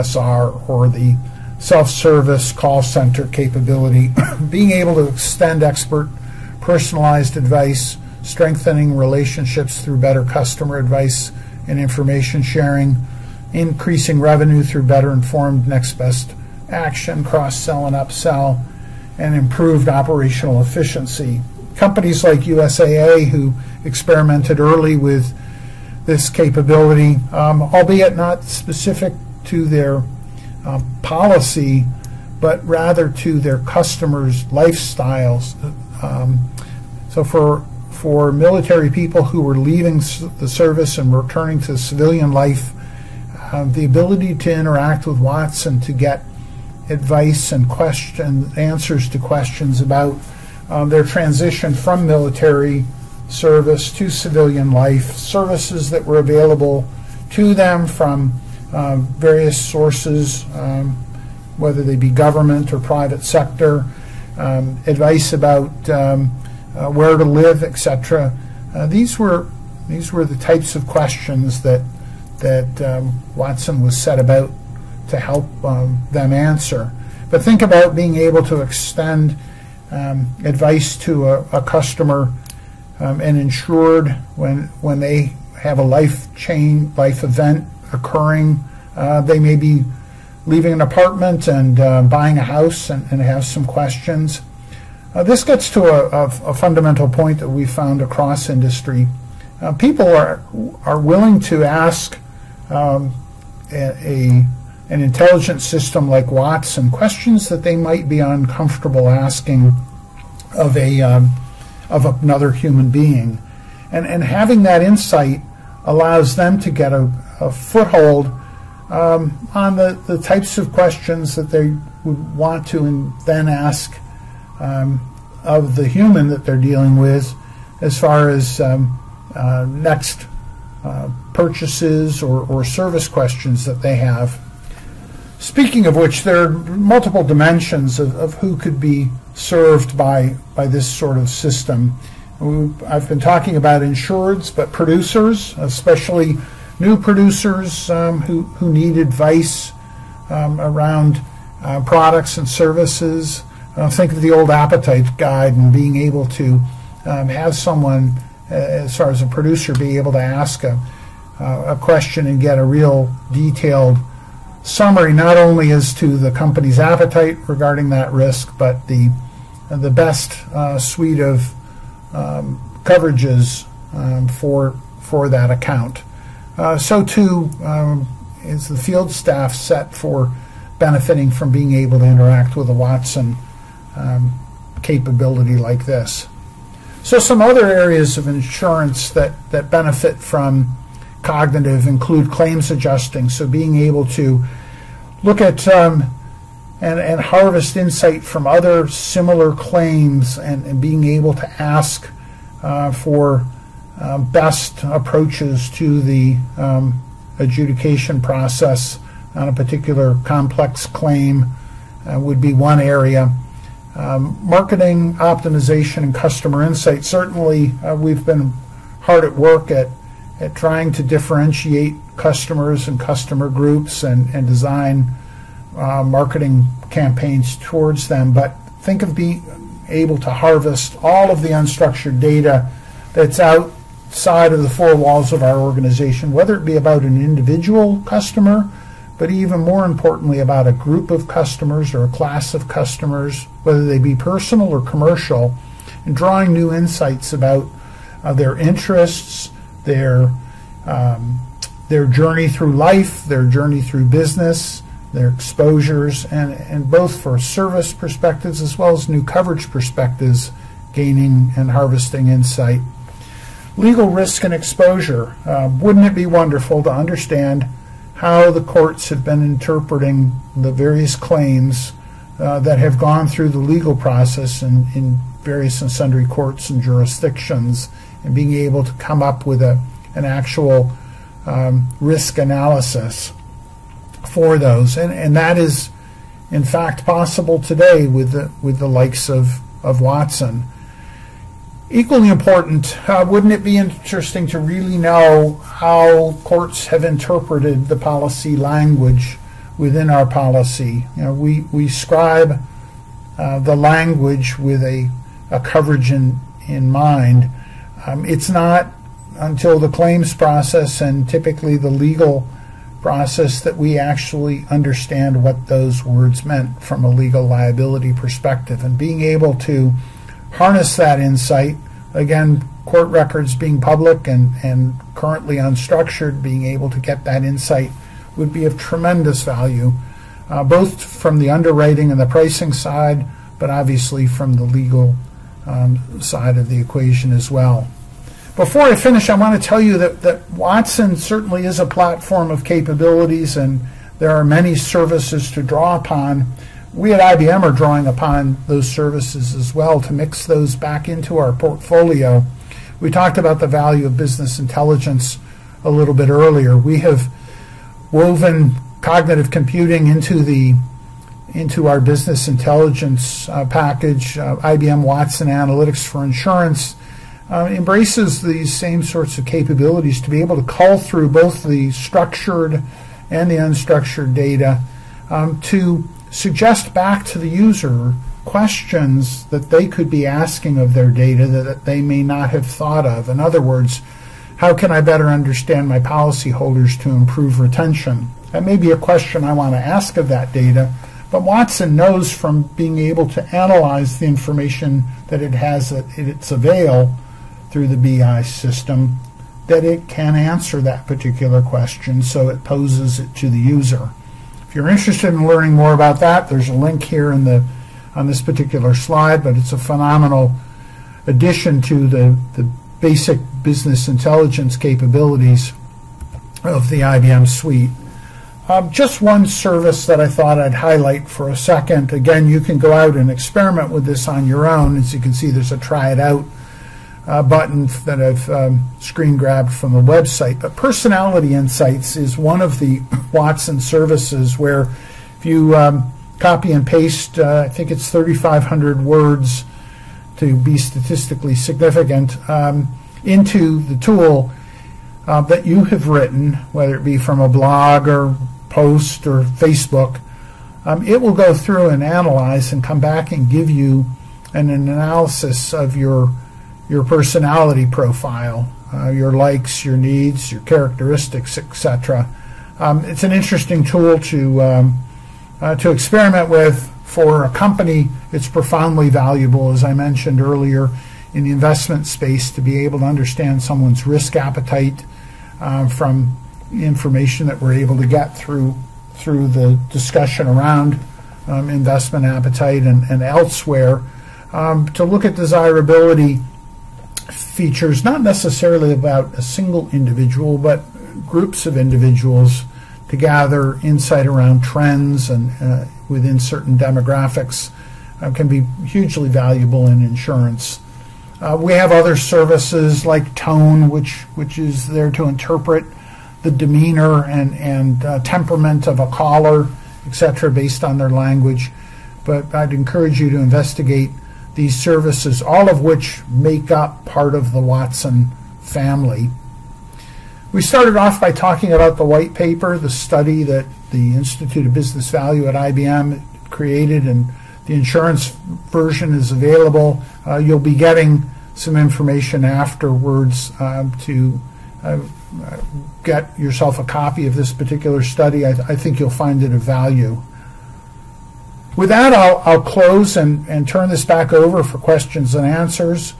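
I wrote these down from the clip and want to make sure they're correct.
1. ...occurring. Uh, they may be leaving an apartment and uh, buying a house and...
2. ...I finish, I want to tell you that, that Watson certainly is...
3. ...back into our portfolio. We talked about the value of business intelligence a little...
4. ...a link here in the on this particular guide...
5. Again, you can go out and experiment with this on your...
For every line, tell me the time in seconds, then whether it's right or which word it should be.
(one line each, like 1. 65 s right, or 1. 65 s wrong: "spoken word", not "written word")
1. 87 s right
2. 338 s right
3. 350 s right
4. 406 s wrong: "slide", not "guide"
5. 422 s right.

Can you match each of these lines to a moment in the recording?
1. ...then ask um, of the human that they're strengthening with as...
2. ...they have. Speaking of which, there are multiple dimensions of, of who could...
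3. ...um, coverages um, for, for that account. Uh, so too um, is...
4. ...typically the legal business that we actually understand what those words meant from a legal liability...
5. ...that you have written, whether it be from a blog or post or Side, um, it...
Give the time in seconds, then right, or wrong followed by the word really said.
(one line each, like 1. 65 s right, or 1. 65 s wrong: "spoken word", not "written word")
1. 123 s wrong: "dealing", not "strengthening"
2. 133 s right
3. 172 s right
4. 311 s wrong: "process", not "business"
5. 445 s wrong: "Facebook", not "Side".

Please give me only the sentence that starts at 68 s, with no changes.
Uh, these were these were the types of questions that that um, Watson was set about to help um, them answer.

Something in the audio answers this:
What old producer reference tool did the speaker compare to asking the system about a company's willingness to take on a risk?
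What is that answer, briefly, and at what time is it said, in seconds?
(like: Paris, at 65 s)
appetite guide, at 154 s.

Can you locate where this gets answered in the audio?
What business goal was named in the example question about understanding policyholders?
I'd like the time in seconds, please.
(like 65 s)
387 s.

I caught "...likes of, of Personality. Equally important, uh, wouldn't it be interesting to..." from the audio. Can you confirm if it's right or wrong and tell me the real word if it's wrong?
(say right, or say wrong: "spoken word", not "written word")
wrong: "Watson", not "Personality".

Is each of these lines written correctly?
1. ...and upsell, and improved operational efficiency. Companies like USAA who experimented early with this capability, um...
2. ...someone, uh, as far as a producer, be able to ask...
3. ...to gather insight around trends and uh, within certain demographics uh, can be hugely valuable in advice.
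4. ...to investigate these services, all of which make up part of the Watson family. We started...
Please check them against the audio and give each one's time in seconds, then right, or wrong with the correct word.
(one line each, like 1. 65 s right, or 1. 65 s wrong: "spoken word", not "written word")
1. 17 s right
2. 157 s right
3. 493 s wrong: "insurance", not "advice"
4. 513 s right.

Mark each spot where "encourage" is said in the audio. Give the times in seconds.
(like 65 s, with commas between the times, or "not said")
512 s.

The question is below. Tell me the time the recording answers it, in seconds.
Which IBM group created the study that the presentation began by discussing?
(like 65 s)
524 s.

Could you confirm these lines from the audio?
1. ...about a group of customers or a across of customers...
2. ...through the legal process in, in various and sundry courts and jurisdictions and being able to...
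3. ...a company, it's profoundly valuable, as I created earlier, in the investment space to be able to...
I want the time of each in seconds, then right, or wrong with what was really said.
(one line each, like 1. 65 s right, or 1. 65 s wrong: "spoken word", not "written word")
1. 240 s wrong: "class", not "across"
2. 273 s right
3. 467 s wrong: "mentioned", not "created".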